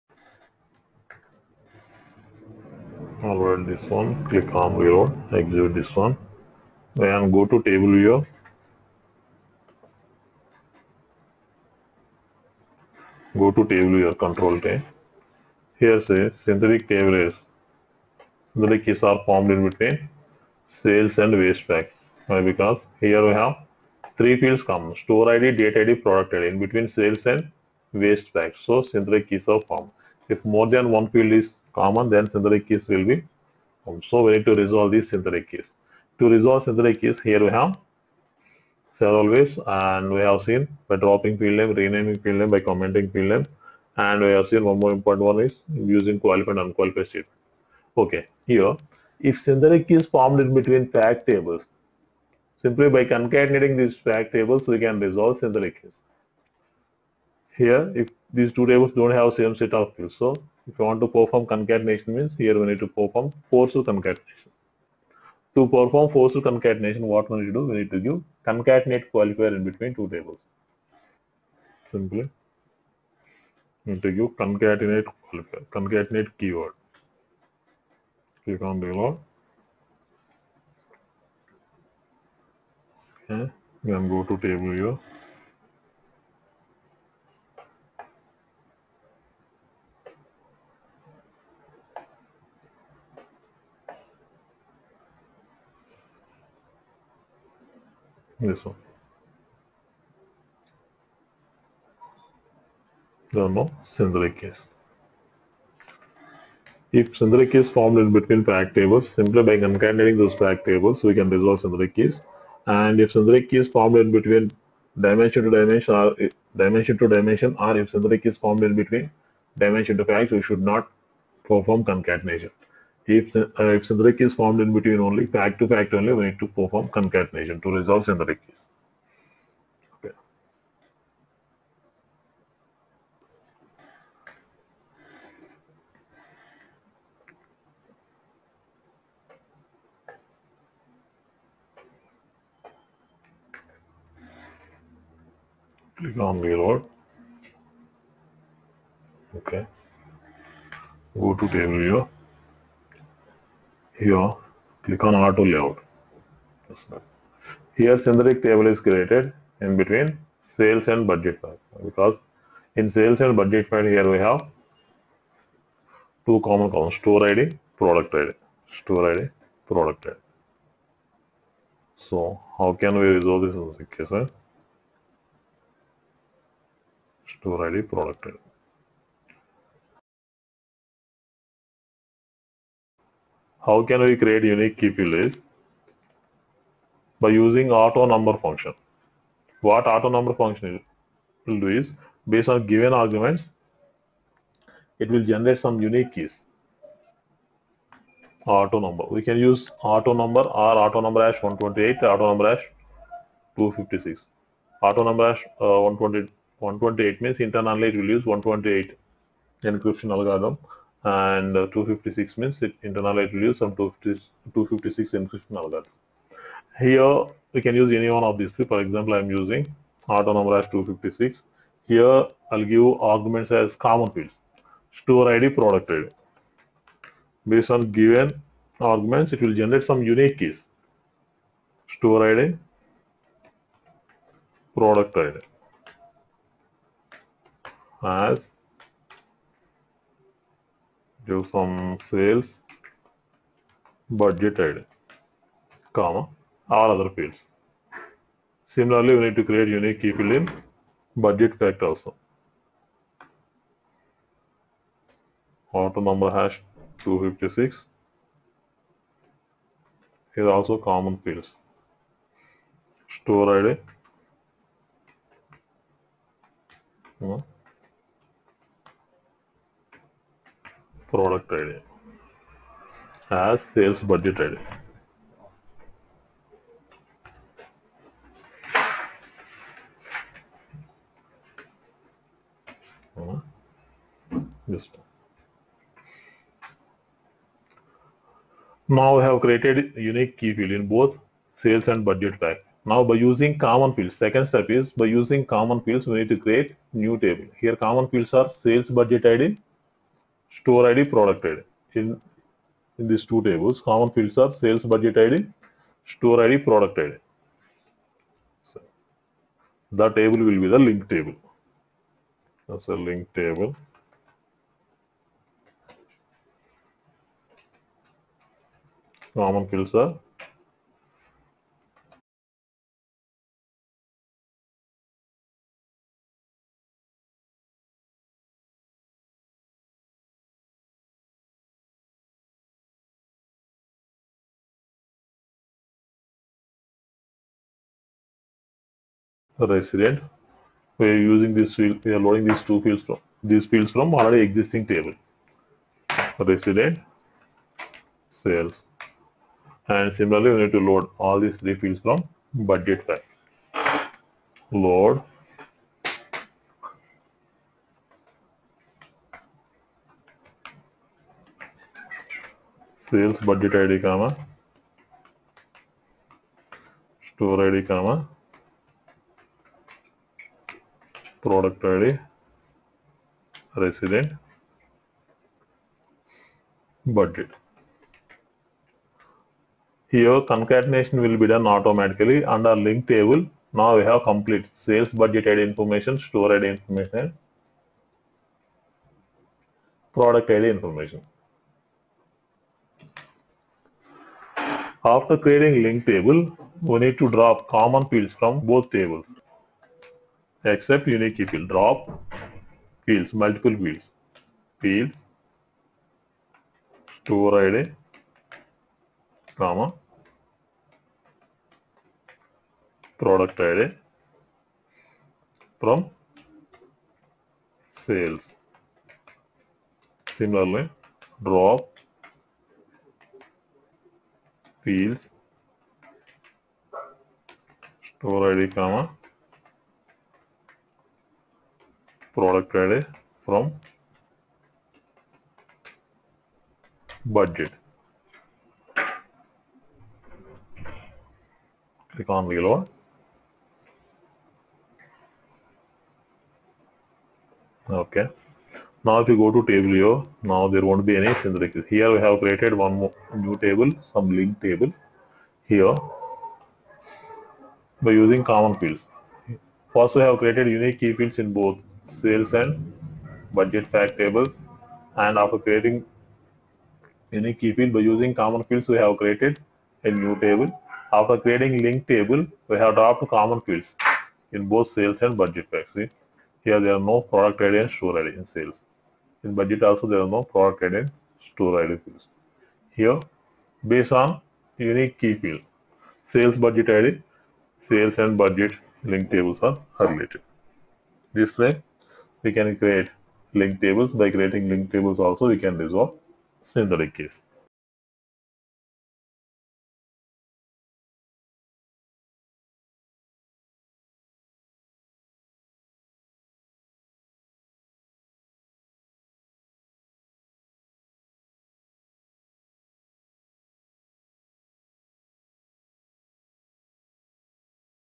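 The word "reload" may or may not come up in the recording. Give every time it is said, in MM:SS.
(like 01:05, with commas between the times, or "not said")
00:04, 02:26, 07:22.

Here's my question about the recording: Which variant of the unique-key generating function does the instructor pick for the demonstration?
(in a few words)
autonumber hash 256.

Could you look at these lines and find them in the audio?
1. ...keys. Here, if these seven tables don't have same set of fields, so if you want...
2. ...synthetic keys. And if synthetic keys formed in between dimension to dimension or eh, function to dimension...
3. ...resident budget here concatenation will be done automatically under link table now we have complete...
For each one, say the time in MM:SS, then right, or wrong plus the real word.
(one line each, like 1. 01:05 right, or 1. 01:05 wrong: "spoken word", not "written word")
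1. 00:55 wrong: "two", not "seven"
2. 01:51 wrong: "dimension", not "function"
3. 06:13 right.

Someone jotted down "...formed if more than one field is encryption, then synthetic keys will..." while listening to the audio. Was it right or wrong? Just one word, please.
wrong.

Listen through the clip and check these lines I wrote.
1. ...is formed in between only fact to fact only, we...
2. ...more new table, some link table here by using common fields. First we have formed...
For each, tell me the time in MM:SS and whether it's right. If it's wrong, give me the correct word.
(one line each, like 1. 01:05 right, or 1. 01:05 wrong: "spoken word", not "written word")
1. 02:04 right
2. 07:32 wrong: "created", not "formed".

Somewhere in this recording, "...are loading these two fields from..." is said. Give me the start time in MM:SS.
05:42.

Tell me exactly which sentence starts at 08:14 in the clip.
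By creating link tables also, we can resolve synthetic case.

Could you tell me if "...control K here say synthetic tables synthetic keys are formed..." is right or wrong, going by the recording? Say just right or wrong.
right.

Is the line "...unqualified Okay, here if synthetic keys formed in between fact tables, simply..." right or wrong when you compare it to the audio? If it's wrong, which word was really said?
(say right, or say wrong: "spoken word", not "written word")
right.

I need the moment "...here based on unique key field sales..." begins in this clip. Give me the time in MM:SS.
08:03.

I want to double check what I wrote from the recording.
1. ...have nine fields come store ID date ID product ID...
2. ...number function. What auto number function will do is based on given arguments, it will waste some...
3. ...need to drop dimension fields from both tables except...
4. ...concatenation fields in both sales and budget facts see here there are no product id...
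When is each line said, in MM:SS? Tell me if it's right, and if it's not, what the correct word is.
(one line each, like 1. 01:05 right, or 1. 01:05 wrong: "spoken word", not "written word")
1. 00:23 wrong: "three", not "nine"
2. 03:08 wrong: "generate", not "waste"
3. 06:37 wrong: "common", not "dimension"
4. 07:53 wrong: "common", not "concatenation".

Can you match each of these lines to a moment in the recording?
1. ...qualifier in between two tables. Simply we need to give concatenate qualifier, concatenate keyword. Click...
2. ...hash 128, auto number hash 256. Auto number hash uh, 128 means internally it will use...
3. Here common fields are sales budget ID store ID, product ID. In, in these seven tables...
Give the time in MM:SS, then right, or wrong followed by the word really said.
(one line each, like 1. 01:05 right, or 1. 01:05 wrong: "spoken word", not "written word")
1. 01:09 right
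2. 03:21 right
3. 04:57 wrong: "two", not "seven".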